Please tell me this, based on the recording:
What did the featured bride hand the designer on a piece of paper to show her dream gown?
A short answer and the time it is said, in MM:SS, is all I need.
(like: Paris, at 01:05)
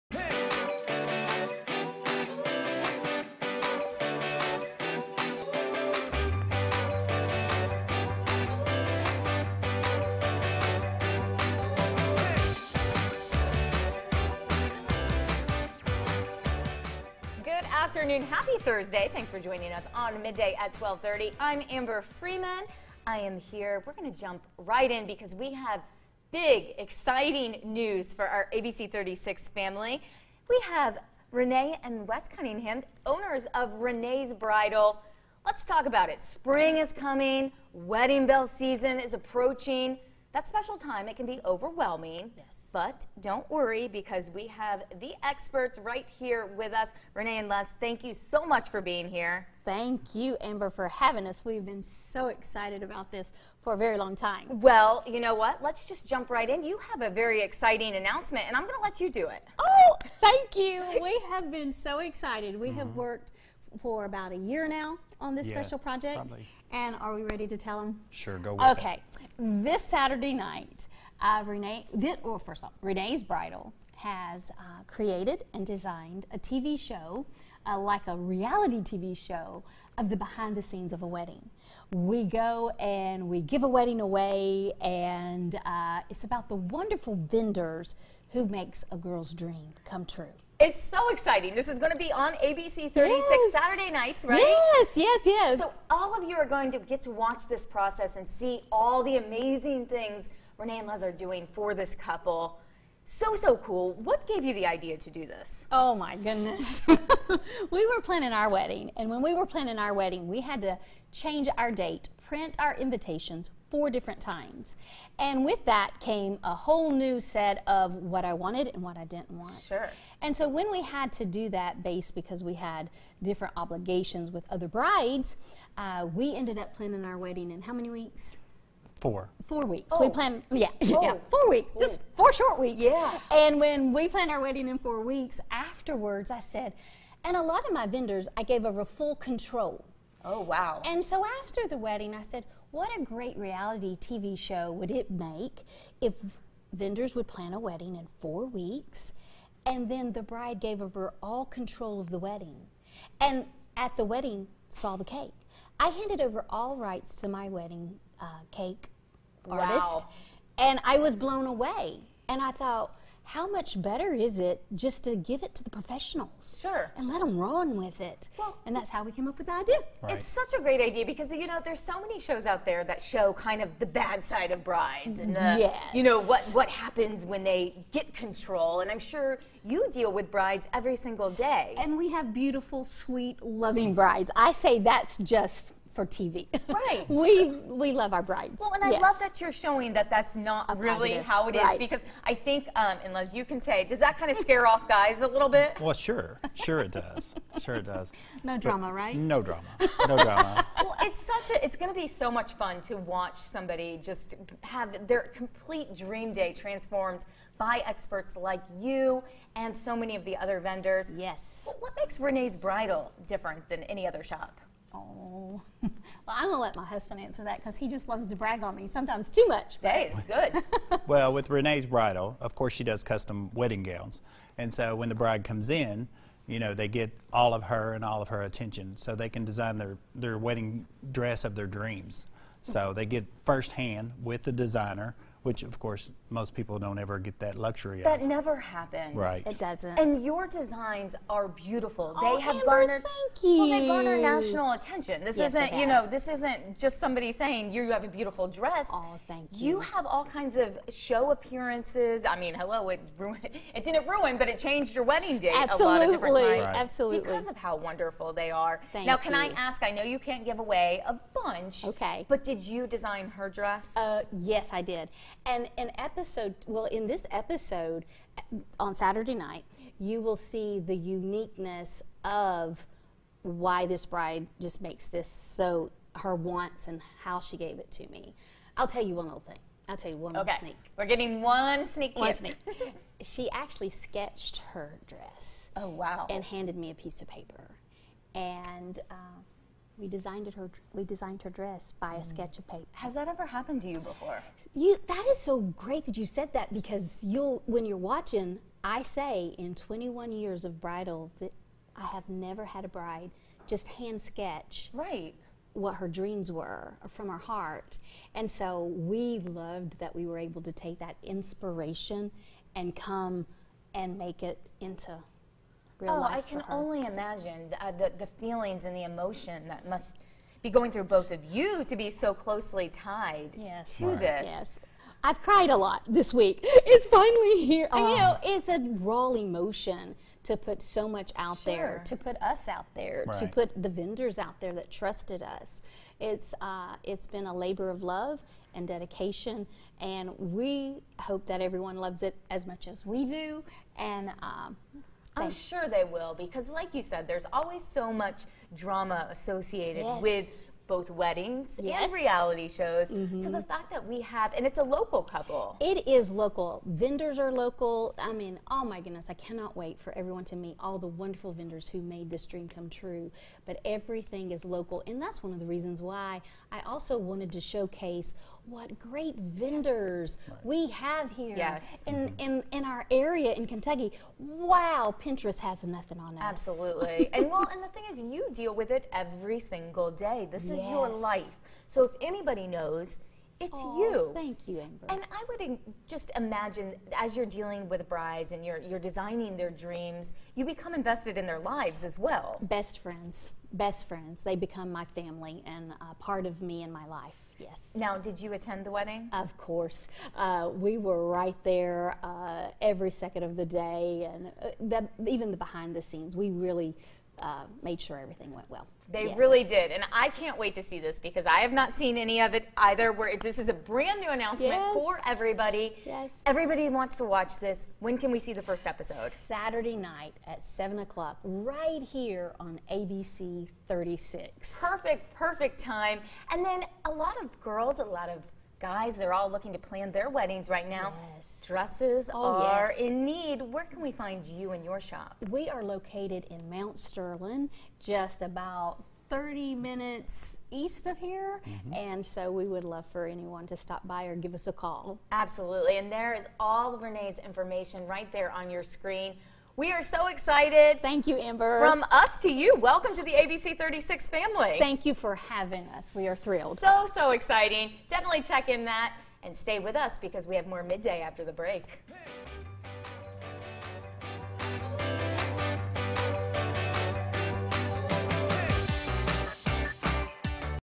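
A sketch, at 04:43.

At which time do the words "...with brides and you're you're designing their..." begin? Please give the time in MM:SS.
06:27.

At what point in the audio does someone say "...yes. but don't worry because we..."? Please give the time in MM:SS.
00:42.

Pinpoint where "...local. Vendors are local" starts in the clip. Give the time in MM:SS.
05:56.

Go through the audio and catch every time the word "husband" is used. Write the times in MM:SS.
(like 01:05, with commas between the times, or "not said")
03:36.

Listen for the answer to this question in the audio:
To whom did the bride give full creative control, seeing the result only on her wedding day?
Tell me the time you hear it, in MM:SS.
02:38.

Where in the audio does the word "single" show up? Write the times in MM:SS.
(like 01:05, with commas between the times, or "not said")
03:00, 06:19.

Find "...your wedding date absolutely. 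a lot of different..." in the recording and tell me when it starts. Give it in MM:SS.
04:14.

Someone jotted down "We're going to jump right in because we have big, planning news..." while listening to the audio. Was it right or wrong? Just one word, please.
wrong.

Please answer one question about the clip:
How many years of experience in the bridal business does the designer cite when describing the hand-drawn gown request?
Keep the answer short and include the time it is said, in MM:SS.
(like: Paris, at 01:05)
21, at 04:59.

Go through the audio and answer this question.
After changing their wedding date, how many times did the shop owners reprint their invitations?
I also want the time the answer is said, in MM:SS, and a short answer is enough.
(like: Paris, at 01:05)
4 times, at 01:53.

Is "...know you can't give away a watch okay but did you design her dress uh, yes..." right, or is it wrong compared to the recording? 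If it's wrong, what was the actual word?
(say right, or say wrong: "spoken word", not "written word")
wrong: "bunch", not "watch".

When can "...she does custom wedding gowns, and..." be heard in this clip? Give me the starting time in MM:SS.
03:42.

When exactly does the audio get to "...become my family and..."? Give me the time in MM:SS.
06:34.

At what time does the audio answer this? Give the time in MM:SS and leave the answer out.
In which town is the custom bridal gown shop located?
07:16.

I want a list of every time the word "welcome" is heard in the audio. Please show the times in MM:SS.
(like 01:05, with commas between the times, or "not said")
07:32.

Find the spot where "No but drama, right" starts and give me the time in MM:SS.
03:18.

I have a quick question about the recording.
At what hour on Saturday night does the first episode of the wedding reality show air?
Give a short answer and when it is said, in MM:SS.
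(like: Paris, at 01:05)
7 o'clock, at 07:00.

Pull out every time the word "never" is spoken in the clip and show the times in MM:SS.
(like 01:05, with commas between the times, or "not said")
03:58, 05:02.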